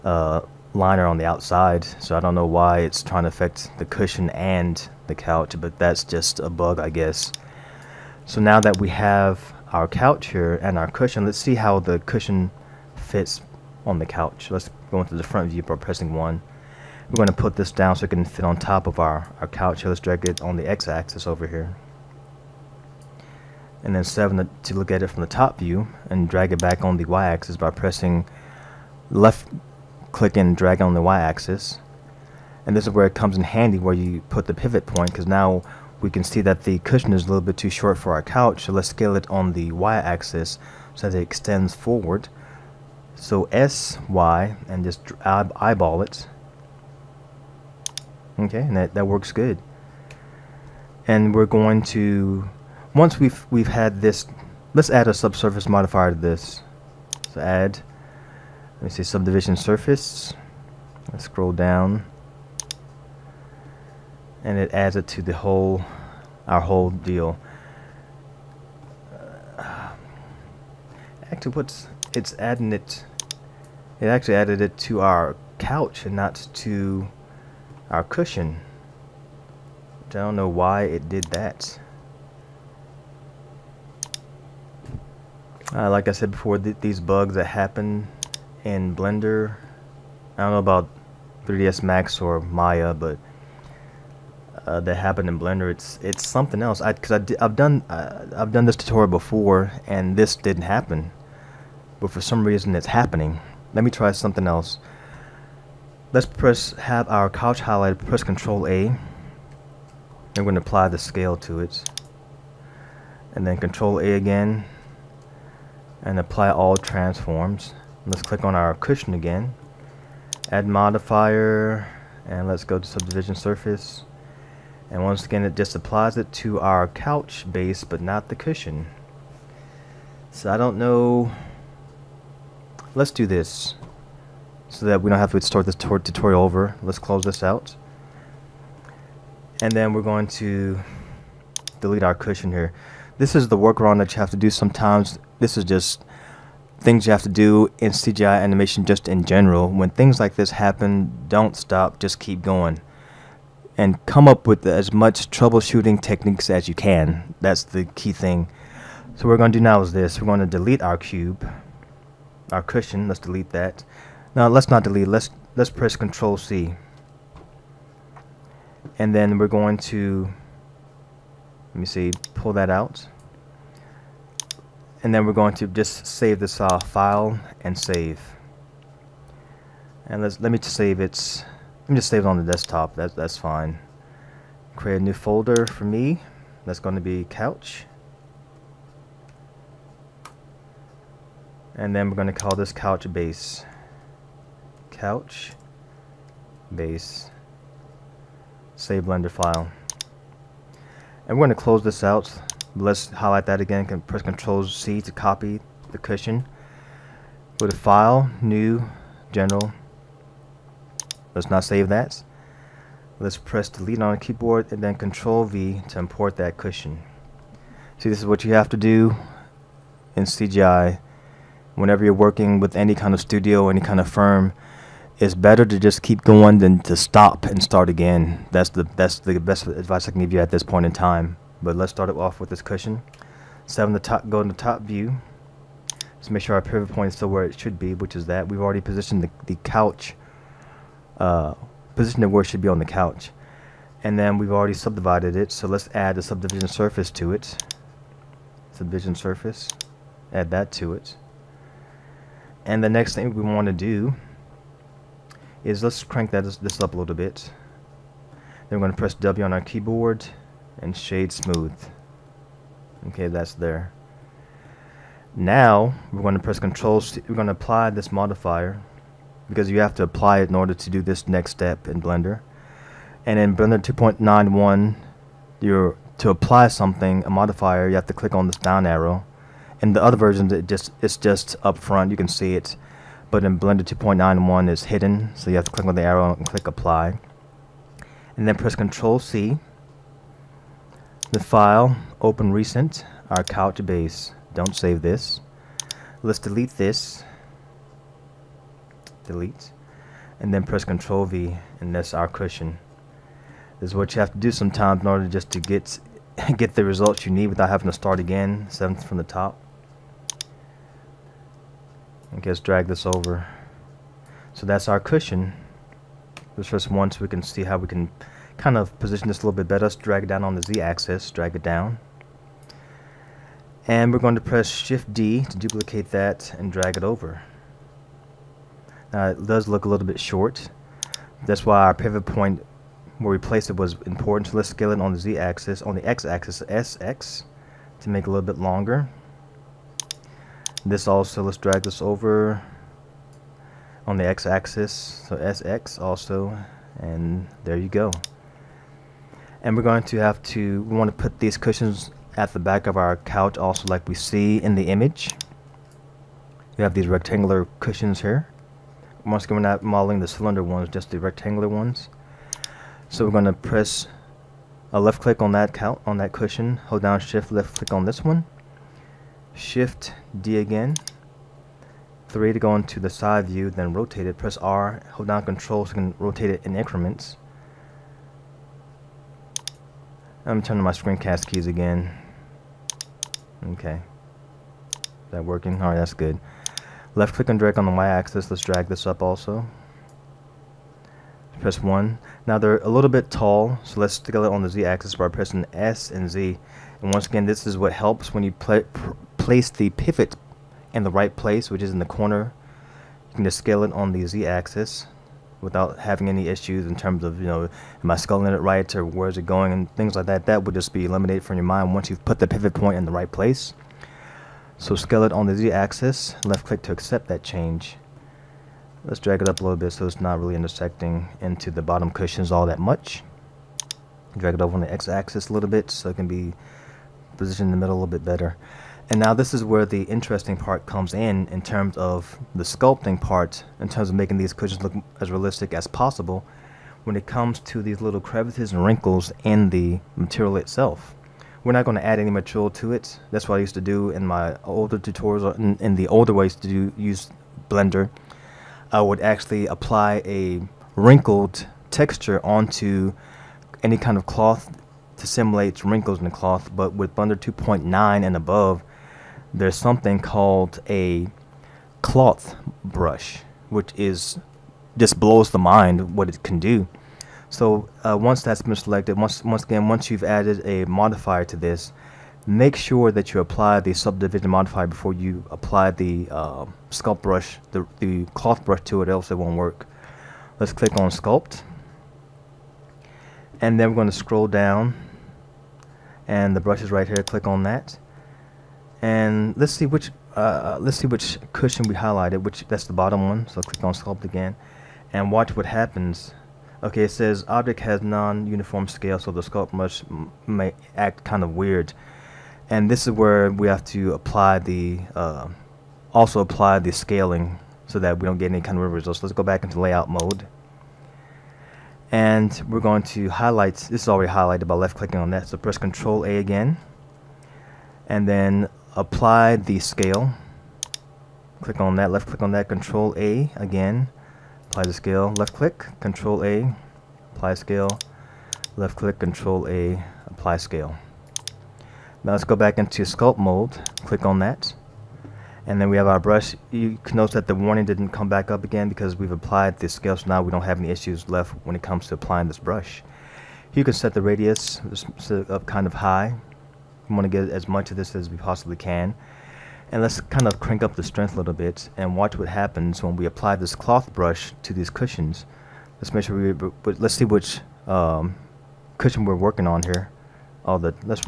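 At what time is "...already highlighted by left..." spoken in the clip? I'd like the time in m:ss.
8:34.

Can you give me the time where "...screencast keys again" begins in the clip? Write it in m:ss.
6:20.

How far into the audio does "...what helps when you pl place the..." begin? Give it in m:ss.
6:37.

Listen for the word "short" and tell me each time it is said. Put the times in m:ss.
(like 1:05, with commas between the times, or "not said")
0:37, 5:30.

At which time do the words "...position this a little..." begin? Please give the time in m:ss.
5:18.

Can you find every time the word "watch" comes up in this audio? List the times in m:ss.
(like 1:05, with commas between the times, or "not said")
8:15, 9:12.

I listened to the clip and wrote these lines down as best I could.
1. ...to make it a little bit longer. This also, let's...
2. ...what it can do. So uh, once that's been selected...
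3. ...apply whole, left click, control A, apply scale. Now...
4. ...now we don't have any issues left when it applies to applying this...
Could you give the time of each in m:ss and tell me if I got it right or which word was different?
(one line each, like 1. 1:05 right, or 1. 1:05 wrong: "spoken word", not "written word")
1. 5:37 right
2. 7:46 right
3. 8:47 wrong: "scale", not "whole"
4. 9:00 wrong: "comes", not "applies".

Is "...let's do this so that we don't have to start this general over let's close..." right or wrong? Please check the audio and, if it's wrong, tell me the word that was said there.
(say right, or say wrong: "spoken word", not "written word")
wrong: "tutorial", not "general".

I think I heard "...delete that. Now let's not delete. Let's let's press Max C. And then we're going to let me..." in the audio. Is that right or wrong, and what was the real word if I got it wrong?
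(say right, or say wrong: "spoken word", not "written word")
wrong: "Control", not "Max".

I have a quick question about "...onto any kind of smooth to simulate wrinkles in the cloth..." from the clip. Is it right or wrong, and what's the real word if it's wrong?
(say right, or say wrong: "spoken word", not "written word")
wrong: "cloth", not "smooth".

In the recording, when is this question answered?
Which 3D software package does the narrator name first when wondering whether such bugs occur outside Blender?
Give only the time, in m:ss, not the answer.
1:31.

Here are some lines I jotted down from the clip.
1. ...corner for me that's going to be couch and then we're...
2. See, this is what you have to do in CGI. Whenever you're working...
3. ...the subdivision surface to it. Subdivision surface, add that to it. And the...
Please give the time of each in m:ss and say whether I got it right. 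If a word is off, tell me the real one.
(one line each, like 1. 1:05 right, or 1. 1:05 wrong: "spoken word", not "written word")
1. 3:05 wrong: "folder", not "corner"
2. 3:37 right
3. 4:06 right.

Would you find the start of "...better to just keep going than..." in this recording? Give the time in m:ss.
3:45.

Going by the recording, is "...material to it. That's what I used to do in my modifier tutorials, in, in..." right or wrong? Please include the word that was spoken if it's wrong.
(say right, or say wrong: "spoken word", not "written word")
wrong: "older", not "modifier".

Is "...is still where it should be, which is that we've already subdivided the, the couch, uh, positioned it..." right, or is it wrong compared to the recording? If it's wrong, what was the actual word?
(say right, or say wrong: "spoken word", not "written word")
wrong: "positioned", not "subdivided".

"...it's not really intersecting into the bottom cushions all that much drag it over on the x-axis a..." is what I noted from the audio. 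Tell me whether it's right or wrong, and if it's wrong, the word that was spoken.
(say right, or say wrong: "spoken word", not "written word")
right.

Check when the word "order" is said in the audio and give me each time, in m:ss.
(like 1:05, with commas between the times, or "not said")
4:30, 5:05.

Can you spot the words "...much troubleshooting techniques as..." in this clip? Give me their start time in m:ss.
2:34.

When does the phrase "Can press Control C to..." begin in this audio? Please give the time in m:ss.
3:23.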